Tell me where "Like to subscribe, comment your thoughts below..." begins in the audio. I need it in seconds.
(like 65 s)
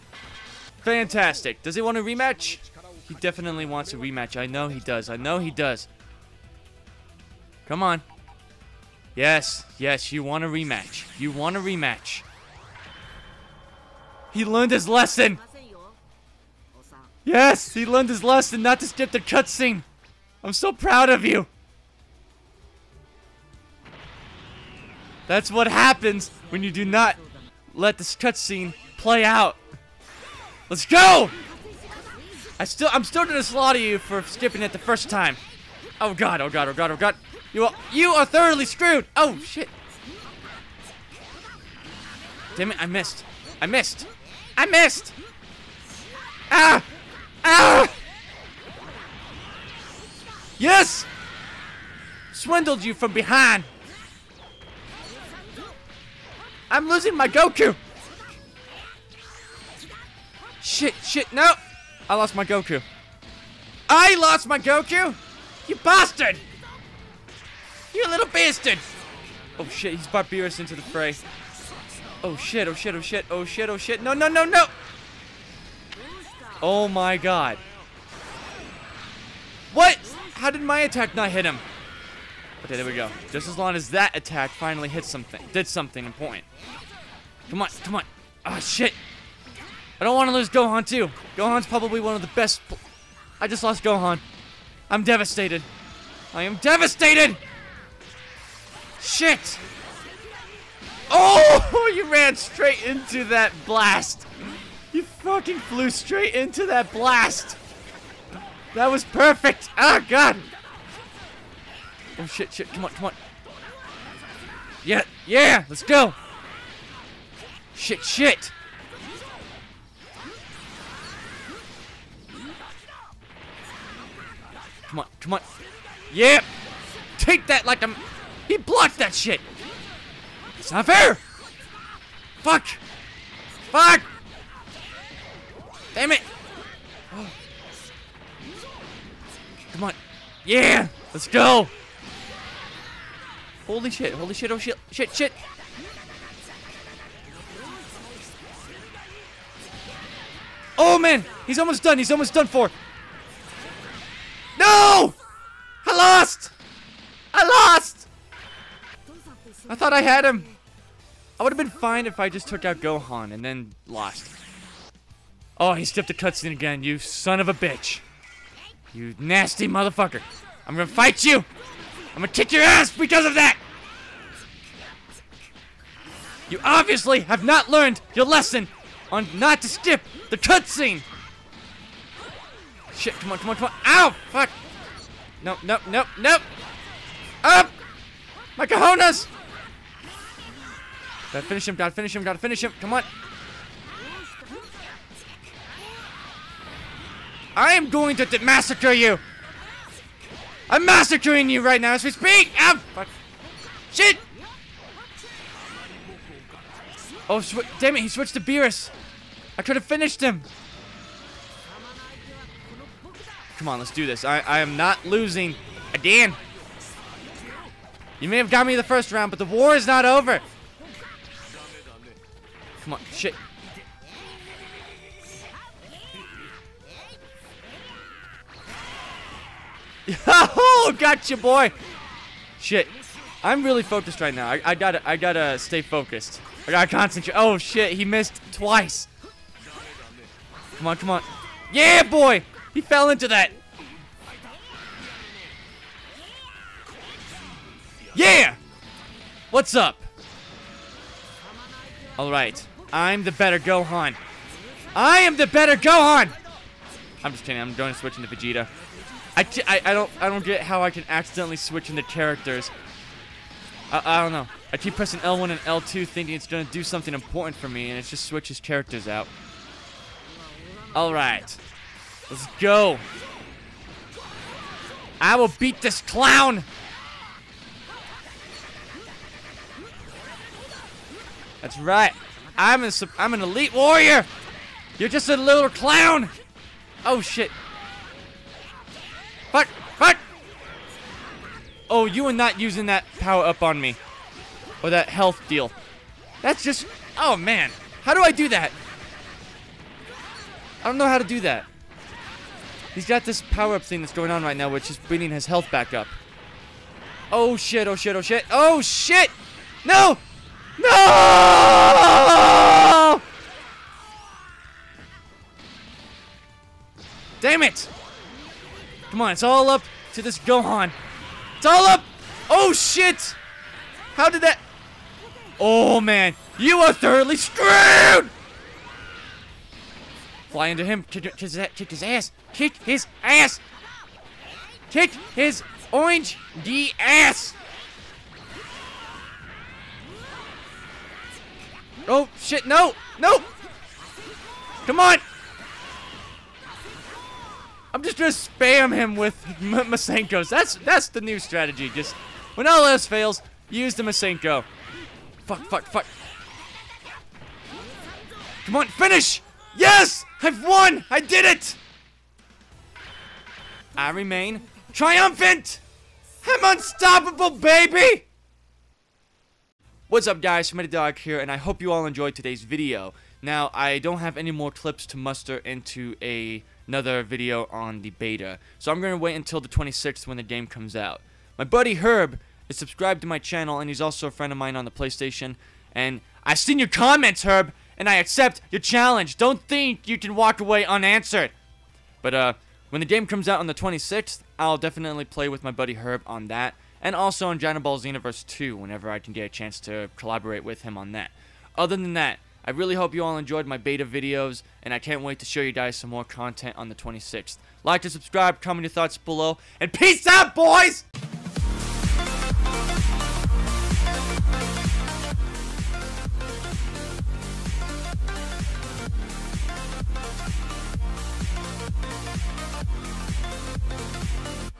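407 s.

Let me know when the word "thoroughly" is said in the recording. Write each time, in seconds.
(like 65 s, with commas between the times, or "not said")
38 s, 326 s.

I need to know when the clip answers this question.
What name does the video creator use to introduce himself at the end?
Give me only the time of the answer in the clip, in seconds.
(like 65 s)
370 s.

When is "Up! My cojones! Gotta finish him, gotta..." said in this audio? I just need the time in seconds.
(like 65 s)
187 s.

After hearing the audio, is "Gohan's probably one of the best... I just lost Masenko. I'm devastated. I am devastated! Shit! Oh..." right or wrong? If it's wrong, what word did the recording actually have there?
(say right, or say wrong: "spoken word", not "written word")
wrong: "Gohan", not "Masenko".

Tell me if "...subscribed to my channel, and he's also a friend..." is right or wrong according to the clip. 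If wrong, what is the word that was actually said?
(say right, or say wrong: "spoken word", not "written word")
right.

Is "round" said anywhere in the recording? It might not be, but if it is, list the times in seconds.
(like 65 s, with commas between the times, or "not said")
219 s.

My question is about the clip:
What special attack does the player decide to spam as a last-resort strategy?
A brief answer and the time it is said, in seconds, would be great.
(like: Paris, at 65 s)
Masenko, at 349 s.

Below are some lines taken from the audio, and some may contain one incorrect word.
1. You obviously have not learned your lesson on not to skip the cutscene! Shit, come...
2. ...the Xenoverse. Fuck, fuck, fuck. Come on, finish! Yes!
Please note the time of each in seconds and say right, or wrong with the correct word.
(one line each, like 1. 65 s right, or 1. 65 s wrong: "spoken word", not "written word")
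1. 176 s right
2. 353 s wrong: "Masenko", not "Xenoverse".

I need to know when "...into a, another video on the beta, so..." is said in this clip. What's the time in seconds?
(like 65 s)
375 s.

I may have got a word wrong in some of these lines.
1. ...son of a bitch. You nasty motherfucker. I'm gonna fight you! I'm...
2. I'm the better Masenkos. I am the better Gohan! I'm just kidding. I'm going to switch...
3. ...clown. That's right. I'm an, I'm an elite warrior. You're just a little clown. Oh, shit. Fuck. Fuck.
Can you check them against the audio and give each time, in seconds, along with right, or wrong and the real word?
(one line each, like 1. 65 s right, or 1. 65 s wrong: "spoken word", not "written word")
1. 166 s right
2. 252 s wrong: "Gohan", not "Masenkos"
3. 276 s right.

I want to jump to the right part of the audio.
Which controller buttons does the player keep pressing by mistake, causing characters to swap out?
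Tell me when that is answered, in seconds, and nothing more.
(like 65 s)
265 s.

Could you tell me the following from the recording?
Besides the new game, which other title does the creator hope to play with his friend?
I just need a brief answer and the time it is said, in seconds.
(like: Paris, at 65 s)
Dragon Ball Xenoverse 2, at 397 s.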